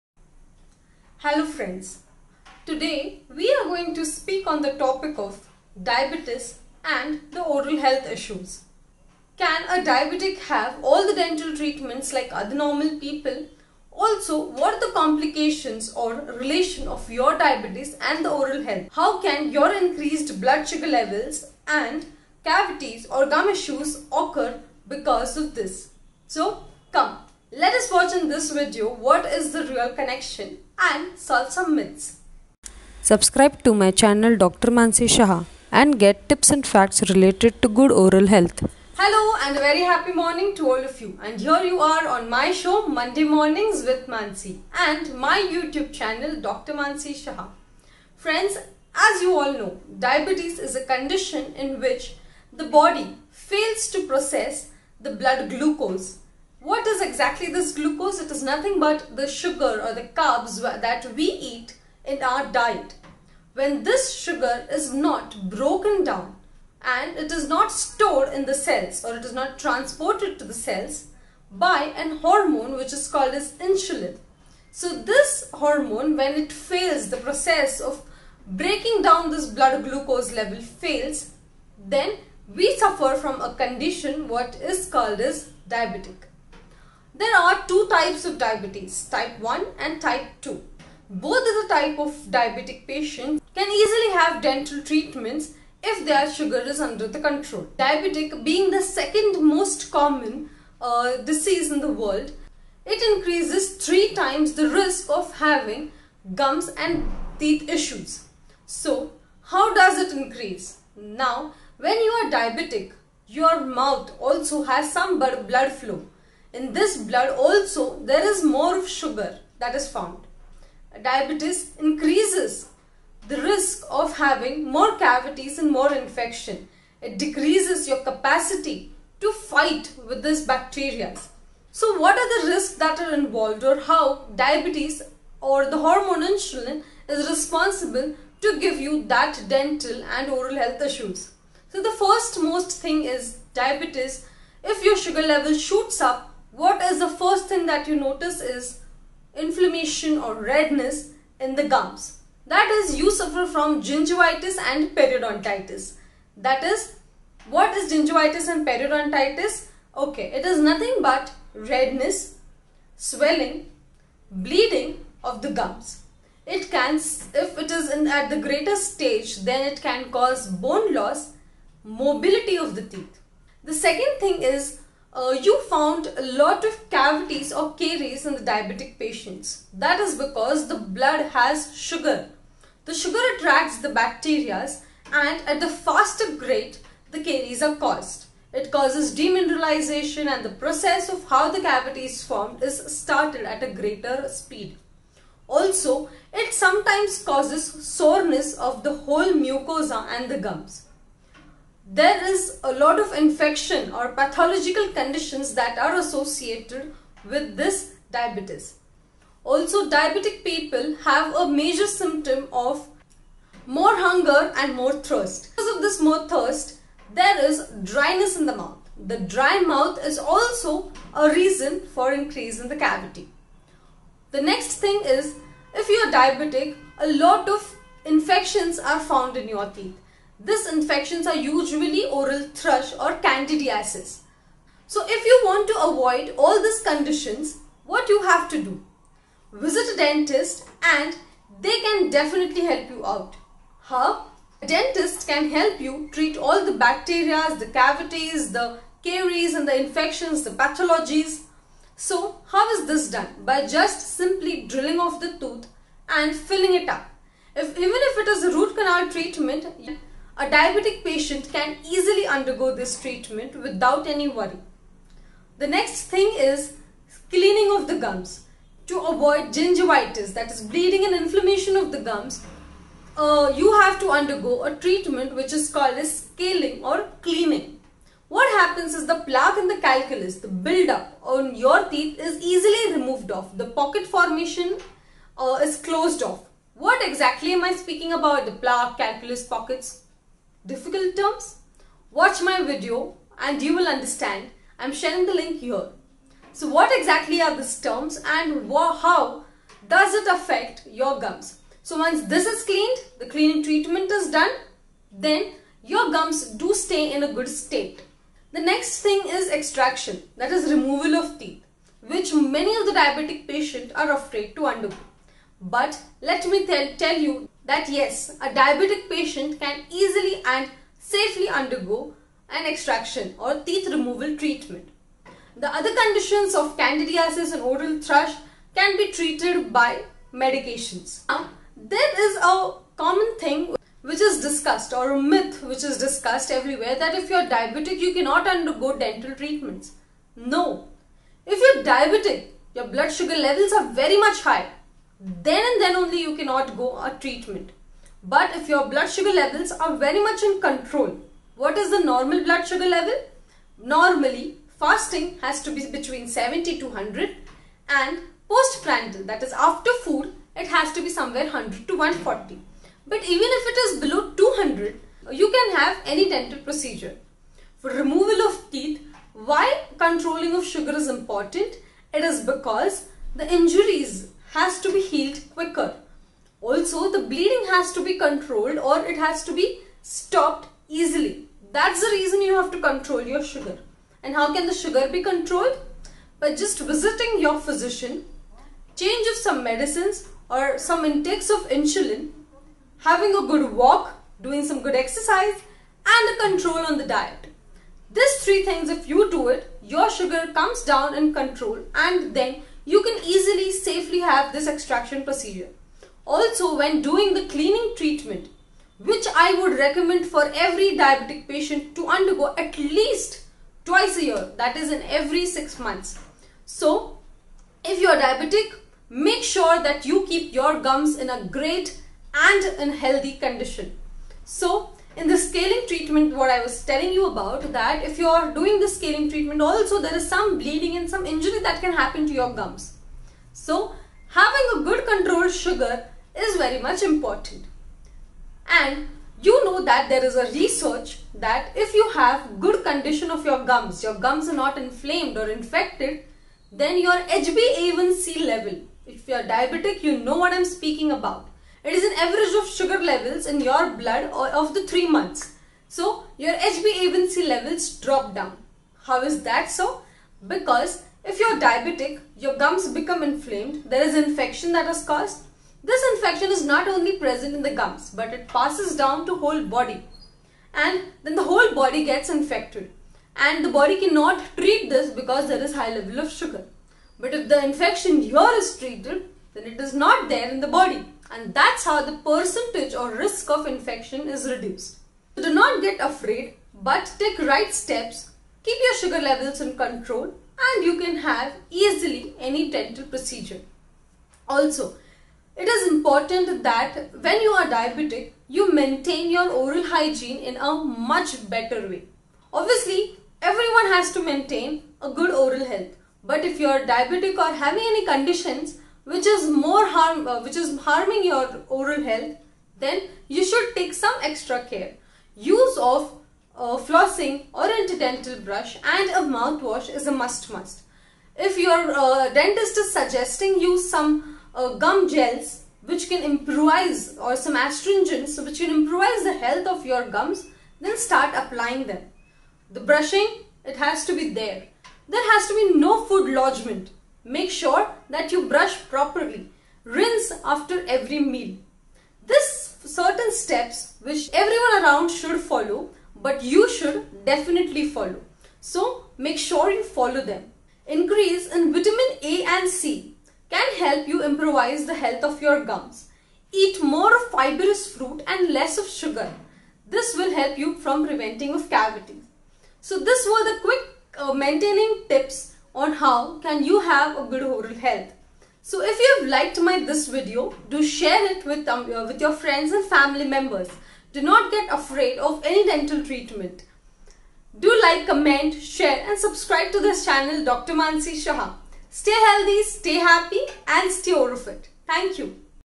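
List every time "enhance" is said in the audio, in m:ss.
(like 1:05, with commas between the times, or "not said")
not said.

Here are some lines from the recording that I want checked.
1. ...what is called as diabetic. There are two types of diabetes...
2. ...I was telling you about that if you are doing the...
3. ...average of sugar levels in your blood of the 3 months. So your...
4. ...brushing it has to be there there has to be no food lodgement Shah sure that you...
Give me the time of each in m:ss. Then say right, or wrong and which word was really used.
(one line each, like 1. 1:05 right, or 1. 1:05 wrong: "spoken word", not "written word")
1. 1:24 right
2. 7:06 right
3. 7:32 right
4. 8:52 wrong: "Make", not "Shah".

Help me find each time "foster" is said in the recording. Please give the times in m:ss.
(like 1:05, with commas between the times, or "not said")
not said.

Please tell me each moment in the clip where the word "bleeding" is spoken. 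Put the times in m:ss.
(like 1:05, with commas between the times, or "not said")
2:44, 4:30, 6:17, 7:10.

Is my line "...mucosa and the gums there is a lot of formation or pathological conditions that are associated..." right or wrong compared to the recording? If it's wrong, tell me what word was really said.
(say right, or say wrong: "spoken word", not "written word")
wrong: "infection", not "formation".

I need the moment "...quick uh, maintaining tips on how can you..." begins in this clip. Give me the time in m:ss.
9:23.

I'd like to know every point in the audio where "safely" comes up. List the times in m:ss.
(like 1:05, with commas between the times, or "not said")
5:20, 6:43.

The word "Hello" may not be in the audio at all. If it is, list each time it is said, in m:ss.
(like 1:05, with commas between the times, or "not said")
0:01, 0:38.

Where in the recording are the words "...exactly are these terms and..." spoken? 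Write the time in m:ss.
4:56.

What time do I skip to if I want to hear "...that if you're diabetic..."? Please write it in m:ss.
5:36.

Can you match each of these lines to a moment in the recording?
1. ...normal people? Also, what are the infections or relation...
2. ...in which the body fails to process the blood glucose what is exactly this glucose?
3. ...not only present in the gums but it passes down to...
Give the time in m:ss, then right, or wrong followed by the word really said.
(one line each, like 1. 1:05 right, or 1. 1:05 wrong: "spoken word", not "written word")
1. 0:12 wrong: "complications", not "infections"
2. 0:51 right
3. 7:46 right.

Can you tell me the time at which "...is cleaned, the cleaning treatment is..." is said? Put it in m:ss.
5:02.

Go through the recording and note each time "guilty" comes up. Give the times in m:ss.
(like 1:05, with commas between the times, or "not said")
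not said.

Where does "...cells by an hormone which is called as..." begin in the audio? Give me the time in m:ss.
1:10.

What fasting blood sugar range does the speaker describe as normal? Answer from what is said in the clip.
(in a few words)
70 to 100.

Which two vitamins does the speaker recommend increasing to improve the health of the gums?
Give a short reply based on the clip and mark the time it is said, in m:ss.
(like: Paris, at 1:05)
Vitamin A and C, at 9:11.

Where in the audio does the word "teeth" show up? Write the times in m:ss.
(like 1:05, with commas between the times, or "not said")
1:47, 2:52, 3:49, 4:41, 5:11, 5:23, 6:08.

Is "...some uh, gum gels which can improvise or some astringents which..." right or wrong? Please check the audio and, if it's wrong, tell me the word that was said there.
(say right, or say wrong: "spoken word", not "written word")
right.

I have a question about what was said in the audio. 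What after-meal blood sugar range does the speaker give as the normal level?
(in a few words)
100 to 140.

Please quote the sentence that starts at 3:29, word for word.
Also diabetic people have a major symptom of more hunger and more thirst.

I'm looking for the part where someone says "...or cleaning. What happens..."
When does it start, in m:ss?
4:36.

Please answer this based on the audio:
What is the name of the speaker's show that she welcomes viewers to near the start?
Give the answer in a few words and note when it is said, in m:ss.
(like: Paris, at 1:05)
Monday Mornings with Mansi, at 0:42.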